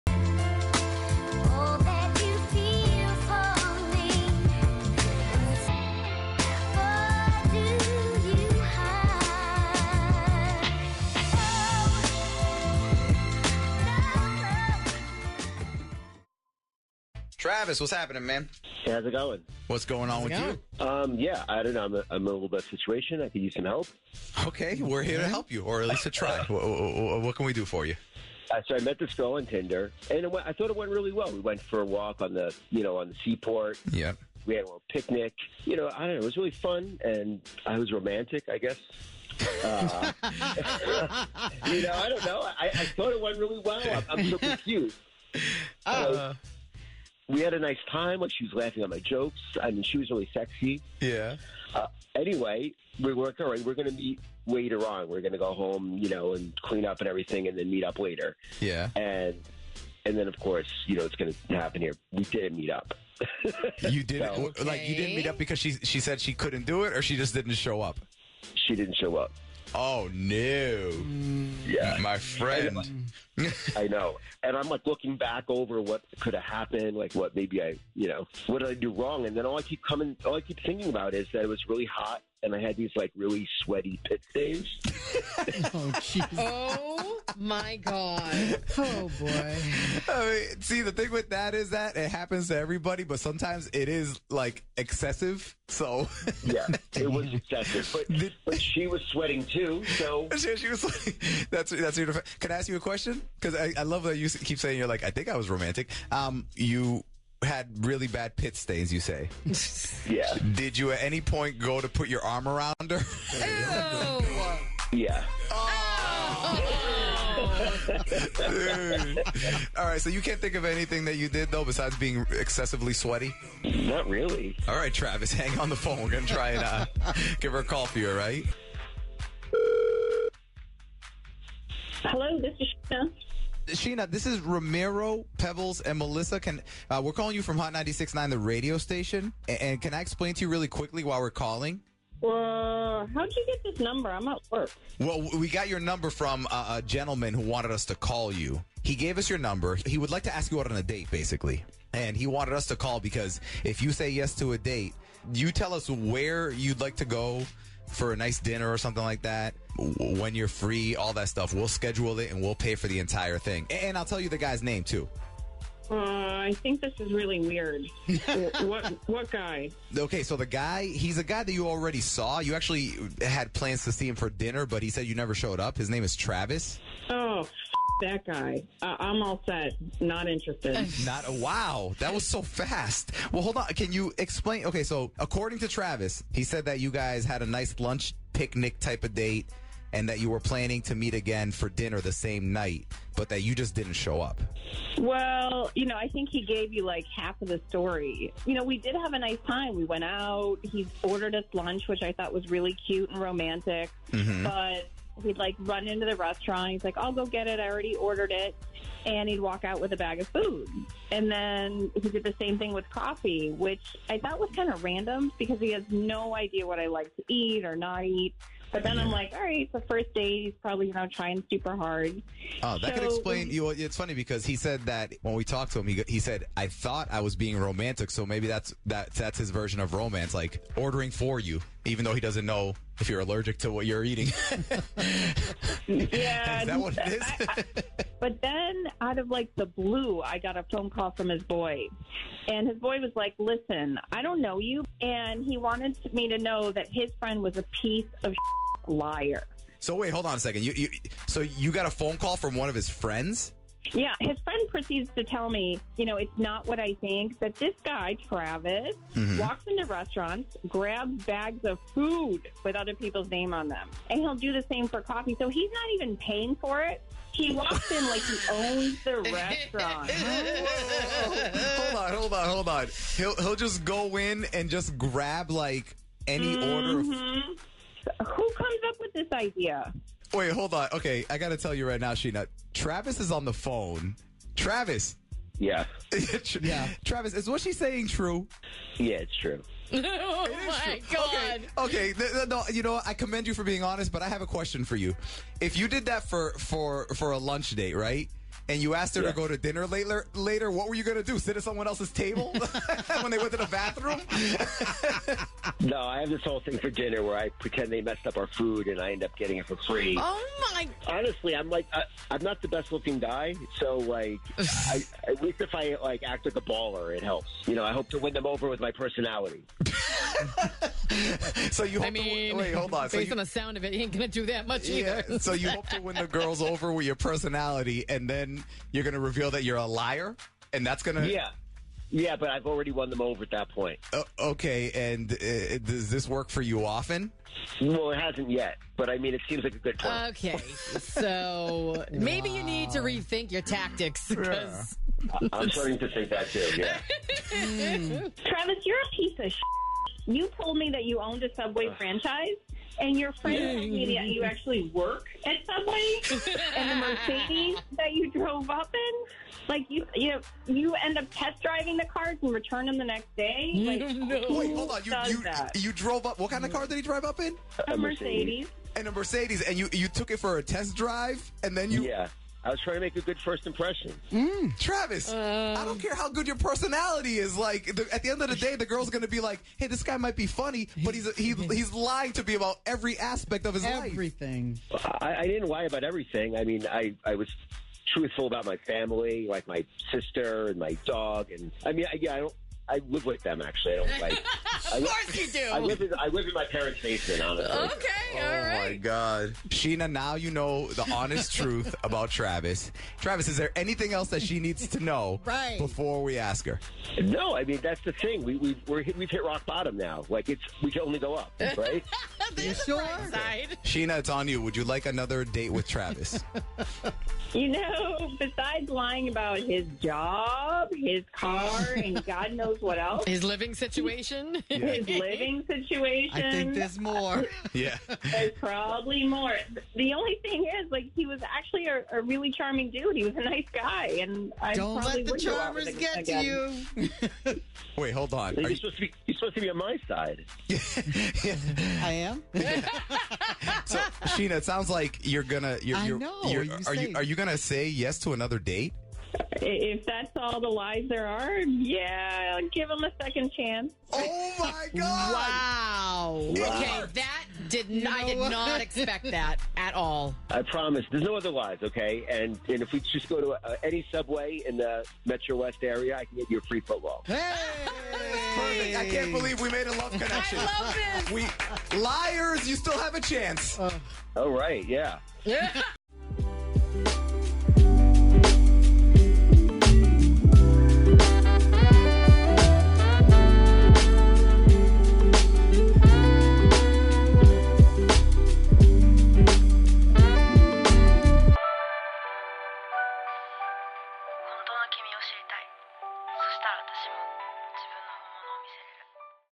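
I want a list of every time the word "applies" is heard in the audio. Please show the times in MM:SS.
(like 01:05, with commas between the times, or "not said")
not said.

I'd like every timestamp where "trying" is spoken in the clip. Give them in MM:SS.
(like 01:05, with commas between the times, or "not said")
03:41, 06:12.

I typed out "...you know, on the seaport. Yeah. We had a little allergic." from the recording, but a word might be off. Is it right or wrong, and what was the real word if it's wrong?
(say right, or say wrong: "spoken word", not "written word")
wrong: "picnic", not "allergic".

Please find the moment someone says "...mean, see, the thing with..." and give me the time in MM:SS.
01:30.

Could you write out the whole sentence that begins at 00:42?
I, I, thought it went really well.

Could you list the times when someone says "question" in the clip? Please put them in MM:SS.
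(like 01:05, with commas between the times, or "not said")
01:42, 04:54.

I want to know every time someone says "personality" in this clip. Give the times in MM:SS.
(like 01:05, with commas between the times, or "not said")
05:18, 05:27, 06:16.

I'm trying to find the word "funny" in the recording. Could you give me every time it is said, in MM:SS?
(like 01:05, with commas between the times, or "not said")
03:43, 06:20.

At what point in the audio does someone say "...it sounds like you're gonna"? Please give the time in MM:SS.
07:24.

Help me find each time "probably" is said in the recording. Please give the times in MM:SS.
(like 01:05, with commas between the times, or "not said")
03:40, 07:08.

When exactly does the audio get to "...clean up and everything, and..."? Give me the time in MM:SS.
00:56.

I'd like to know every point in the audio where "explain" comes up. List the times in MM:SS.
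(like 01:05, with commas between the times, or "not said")
02:20, 03:04, 03:43.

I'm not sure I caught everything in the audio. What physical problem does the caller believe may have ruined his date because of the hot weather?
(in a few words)
Sweaty pit stains.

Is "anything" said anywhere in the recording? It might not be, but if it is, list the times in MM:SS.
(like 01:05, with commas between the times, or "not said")
02:00, 06:43.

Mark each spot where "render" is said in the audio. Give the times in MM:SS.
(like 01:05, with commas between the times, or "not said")
not said.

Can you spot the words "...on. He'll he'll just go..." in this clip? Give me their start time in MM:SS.
04:32.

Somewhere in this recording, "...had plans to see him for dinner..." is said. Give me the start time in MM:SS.
02:53.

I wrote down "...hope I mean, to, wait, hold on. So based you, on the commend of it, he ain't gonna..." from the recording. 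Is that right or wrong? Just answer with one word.
wrong.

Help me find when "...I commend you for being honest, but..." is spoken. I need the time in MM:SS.
04:53.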